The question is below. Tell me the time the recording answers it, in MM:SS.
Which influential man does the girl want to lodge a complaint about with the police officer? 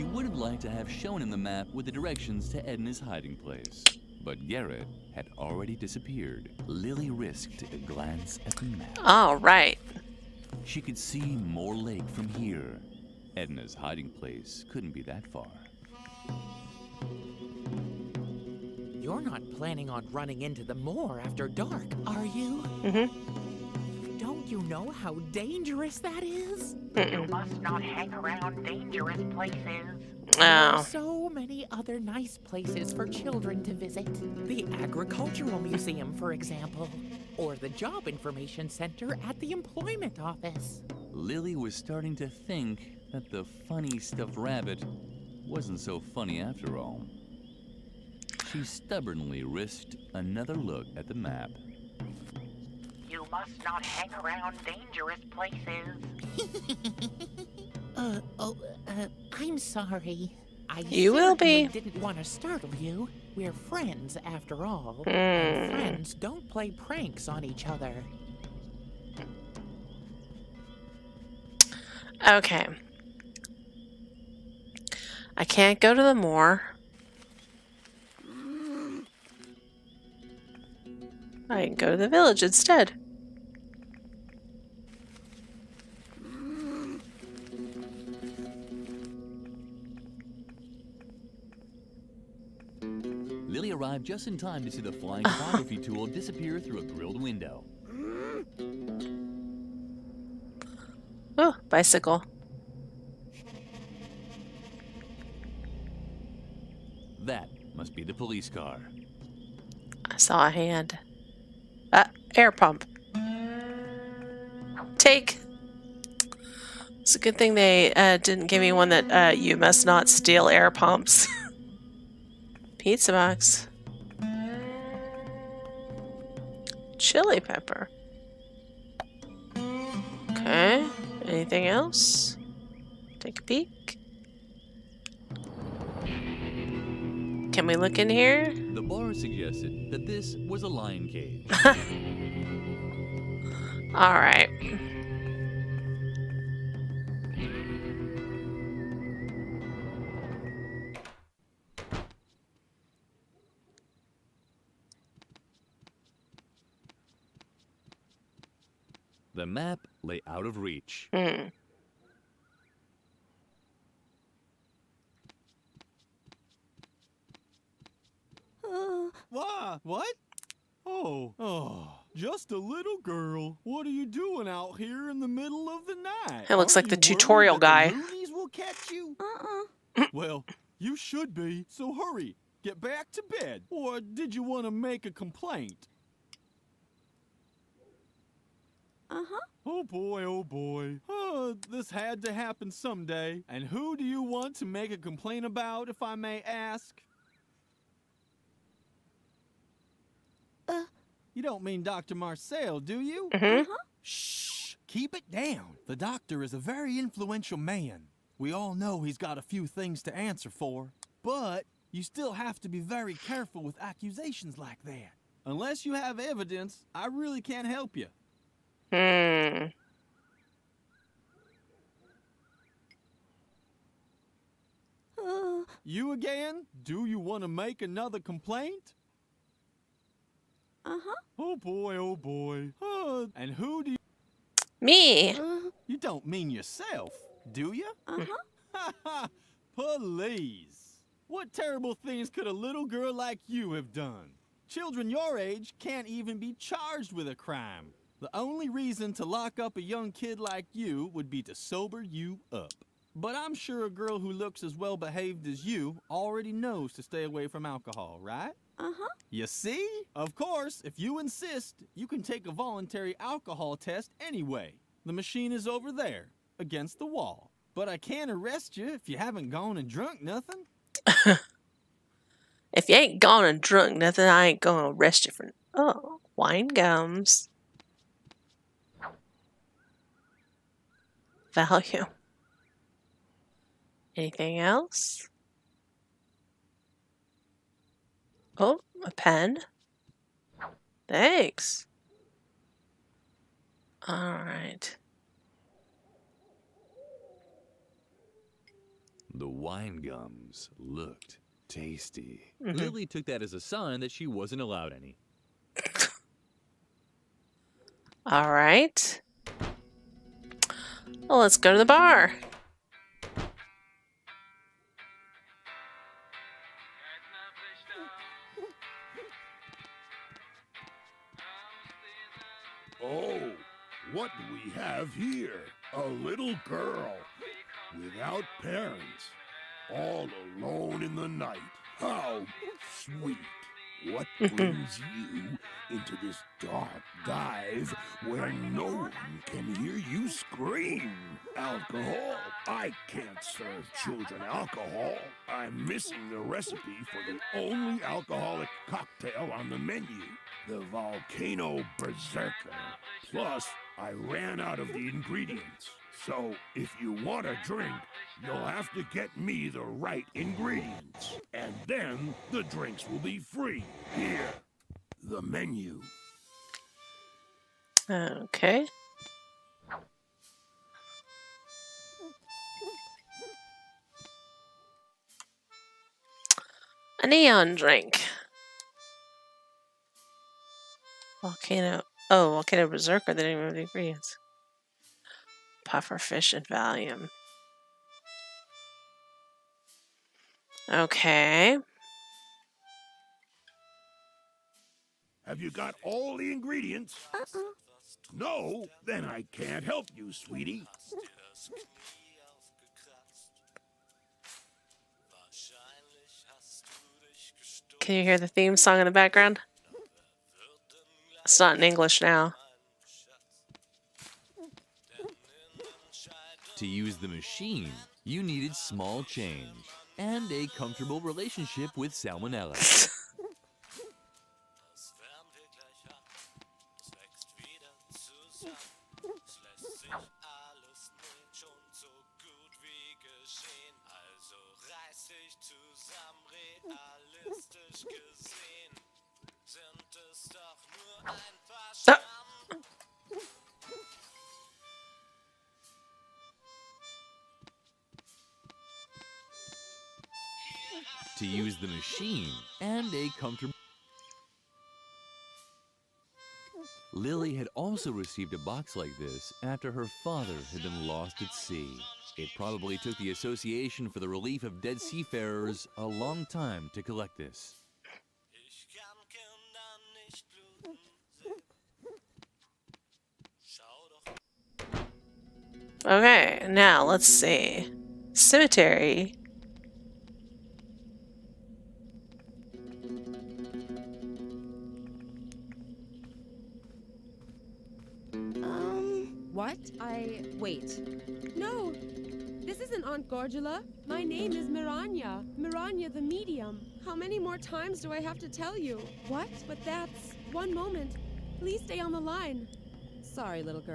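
03:21.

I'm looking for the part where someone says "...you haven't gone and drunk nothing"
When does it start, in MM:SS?
04:29.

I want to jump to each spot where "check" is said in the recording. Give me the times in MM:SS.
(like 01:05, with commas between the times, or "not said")
not said.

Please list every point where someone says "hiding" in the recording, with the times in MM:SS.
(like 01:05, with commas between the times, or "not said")
00:02, 00:13.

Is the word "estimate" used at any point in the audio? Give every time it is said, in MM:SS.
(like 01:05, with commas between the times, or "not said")
not said.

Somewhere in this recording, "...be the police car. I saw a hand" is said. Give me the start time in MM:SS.
01:47.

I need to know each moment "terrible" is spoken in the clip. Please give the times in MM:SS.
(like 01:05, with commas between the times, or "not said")
04:01.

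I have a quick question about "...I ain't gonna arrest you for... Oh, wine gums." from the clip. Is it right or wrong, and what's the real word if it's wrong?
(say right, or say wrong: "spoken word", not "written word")
right.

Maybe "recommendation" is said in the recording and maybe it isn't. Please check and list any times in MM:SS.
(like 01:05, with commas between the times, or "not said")
not said.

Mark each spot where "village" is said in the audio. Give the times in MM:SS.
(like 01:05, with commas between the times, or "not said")
01:22.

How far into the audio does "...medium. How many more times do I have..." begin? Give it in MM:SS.
08:16.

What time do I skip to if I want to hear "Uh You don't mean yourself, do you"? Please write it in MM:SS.
03:55.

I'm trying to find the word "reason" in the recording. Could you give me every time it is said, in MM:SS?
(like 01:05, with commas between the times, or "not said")
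04:08.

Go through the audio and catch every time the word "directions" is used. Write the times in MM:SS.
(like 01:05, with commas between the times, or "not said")
00:01.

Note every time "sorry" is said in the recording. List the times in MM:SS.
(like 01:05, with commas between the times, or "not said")
00:59, 08:23.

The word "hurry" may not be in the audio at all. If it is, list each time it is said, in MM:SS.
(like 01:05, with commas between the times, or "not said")
03:01.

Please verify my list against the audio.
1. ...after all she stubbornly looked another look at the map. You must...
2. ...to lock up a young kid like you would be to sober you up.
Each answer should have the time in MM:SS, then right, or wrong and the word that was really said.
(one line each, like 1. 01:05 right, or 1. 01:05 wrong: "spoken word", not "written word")
1. 00:46 wrong: "risked", not "looked"
2. 04:09 right.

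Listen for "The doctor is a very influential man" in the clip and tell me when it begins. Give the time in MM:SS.
03:25.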